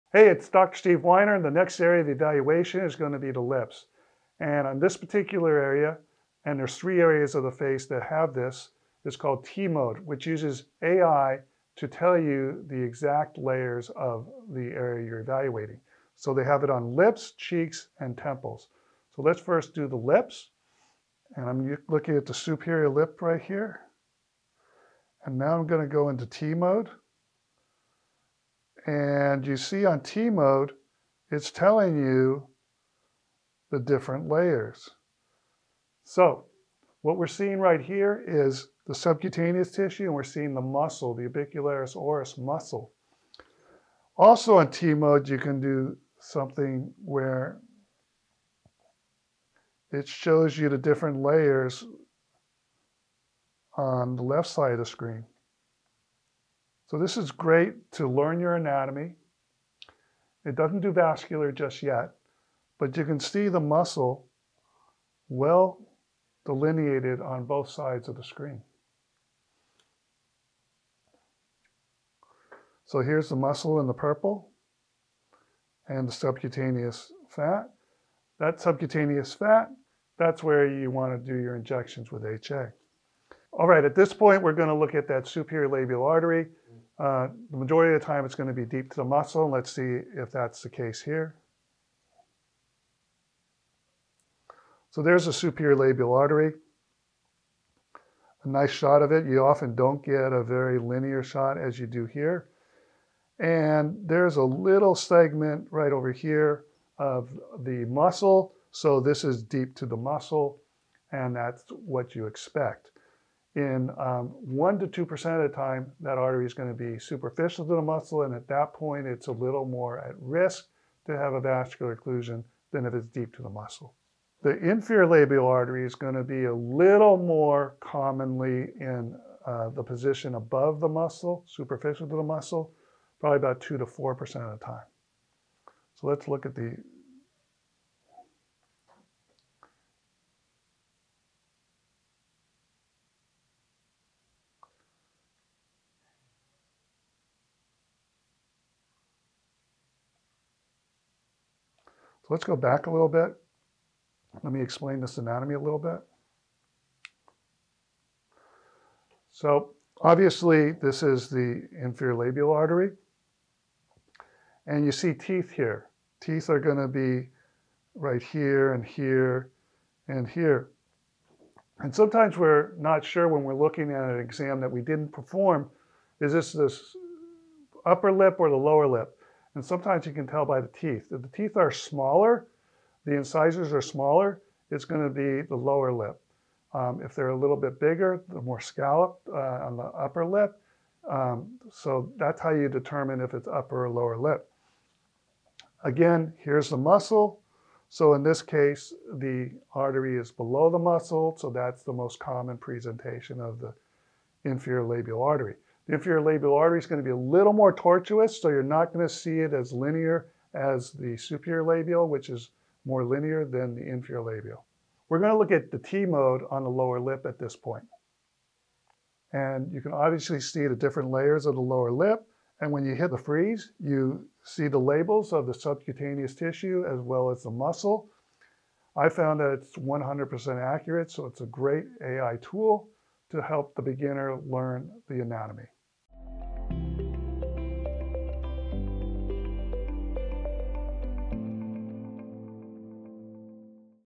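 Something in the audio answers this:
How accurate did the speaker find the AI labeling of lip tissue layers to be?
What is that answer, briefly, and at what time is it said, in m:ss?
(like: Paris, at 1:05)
100%, at 3:49.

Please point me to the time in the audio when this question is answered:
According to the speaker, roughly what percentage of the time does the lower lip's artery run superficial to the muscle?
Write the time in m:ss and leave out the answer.
2:13.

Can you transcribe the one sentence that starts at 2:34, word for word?
Let me explain this anatomy a little bit.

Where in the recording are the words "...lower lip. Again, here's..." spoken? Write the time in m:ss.
3:13.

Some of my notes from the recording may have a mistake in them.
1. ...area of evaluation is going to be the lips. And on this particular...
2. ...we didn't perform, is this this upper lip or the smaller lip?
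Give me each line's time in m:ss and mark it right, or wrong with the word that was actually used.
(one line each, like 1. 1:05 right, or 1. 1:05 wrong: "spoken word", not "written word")
1. 0:01 right
2. 2:54 wrong: "lower", not "smaller".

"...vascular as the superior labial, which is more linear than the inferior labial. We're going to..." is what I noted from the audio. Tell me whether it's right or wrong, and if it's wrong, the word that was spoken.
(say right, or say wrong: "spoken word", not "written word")
wrong: "linear", not "vascular".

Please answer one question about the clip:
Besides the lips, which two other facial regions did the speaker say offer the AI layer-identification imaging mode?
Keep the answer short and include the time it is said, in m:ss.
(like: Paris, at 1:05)
cheeks and temples, at 0:17.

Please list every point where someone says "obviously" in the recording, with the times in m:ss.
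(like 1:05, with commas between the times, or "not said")
2:40, 3:39.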